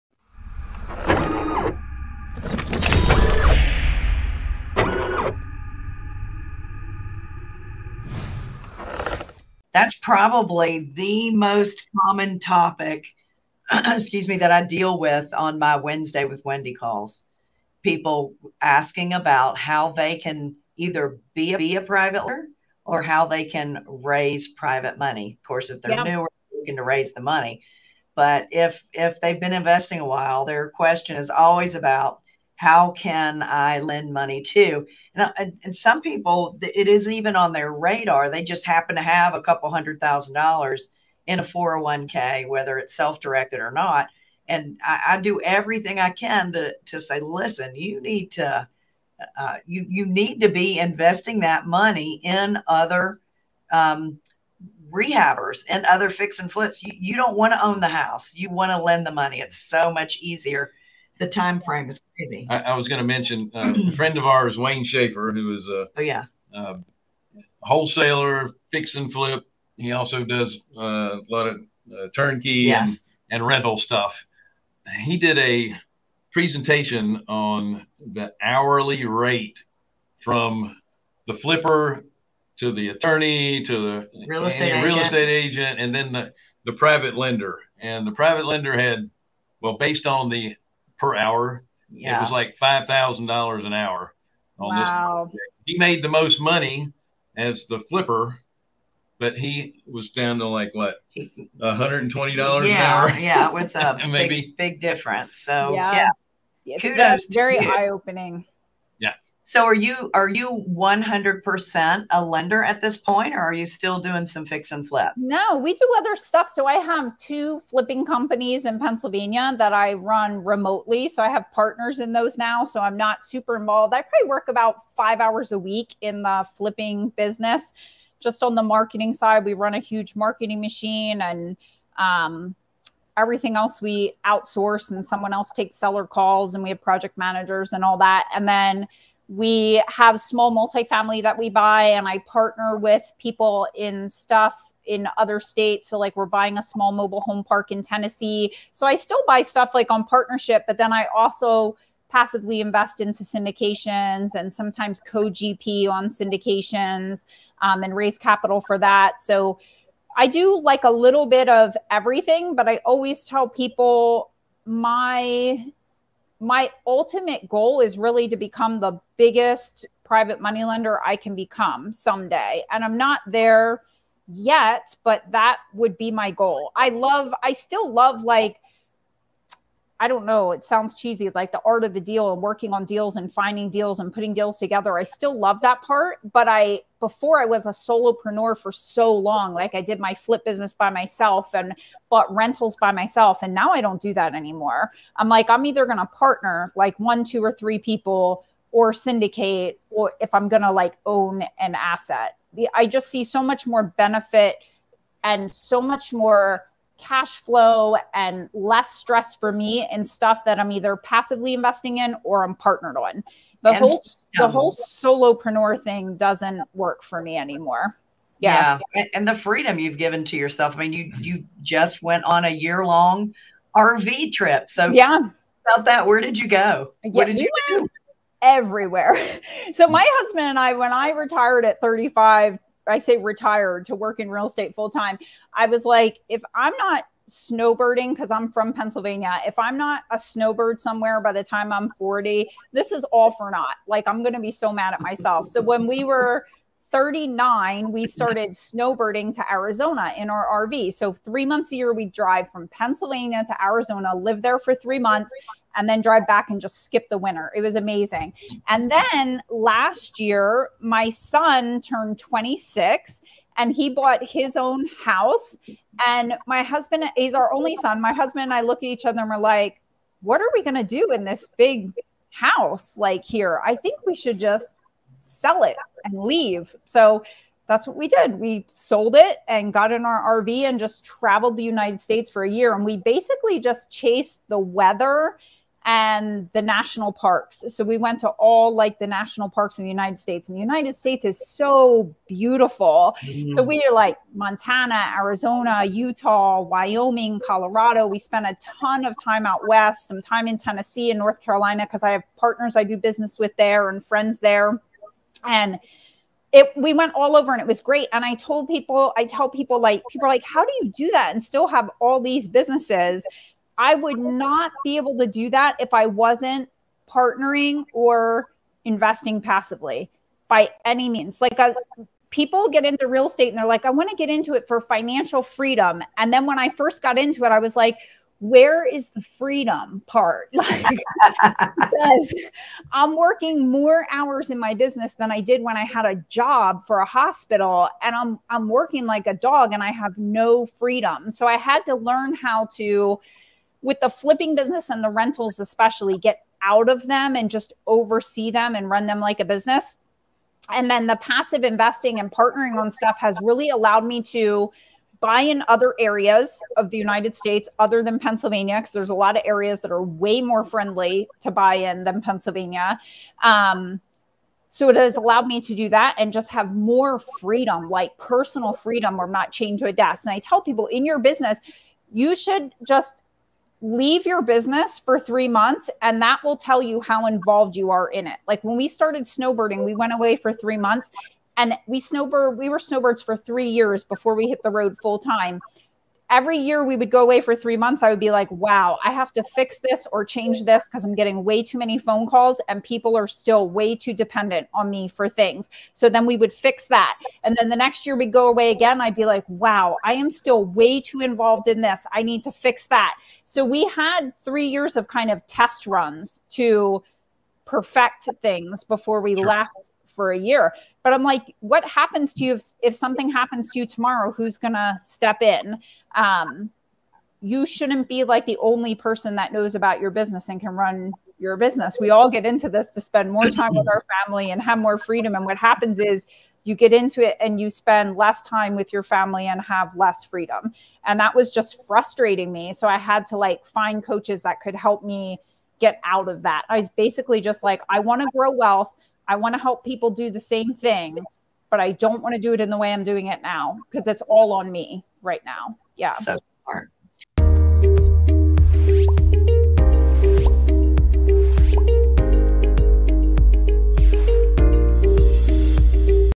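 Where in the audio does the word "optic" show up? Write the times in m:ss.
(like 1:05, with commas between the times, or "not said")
not said.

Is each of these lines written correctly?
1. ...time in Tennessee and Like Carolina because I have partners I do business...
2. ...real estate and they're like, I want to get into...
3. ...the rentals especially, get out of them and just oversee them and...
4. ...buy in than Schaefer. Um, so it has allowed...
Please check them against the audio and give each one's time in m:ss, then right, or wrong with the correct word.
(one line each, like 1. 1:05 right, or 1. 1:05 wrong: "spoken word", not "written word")
1. 5:00 wrong: "North", not "Like"
2. 5:23 right
3. 5:45 right
4. 6:01 wrong: "Pennsylvania", not "Schaefer".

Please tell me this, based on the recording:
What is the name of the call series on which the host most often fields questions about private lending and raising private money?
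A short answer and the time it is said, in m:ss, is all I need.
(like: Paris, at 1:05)
Wednesday with Wendy, at 0:15.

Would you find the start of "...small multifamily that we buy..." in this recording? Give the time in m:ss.
2:20.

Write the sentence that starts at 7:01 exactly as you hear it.
We all get into this to spend more time with our family and have more freedom.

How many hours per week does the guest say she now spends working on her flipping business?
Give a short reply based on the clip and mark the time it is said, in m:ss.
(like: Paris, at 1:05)
5, at 2:04.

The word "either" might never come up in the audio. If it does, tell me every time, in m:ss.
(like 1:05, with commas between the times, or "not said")
0:20, 3:15, 3:30.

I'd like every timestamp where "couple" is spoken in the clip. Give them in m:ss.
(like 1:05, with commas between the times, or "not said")
0:39.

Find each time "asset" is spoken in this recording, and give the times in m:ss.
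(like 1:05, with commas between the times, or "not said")
3:21.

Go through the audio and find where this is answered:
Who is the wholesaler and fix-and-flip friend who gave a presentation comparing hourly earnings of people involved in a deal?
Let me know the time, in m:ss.
1:04.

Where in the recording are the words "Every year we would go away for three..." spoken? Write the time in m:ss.
6:26.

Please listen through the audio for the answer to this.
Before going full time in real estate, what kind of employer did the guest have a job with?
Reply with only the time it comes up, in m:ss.
5:37.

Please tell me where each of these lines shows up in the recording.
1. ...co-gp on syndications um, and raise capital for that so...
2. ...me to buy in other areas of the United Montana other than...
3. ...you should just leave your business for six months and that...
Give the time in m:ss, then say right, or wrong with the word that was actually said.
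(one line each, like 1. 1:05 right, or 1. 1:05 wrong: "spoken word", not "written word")
1. 2:34 right
2. 5:54 wrong: "States", not "Montana"
3. 6:12 wrong: "three", not "six".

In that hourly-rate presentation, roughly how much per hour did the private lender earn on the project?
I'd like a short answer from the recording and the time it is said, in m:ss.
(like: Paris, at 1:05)
$5,000, at 1:32.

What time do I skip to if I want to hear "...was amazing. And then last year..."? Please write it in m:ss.
4:17.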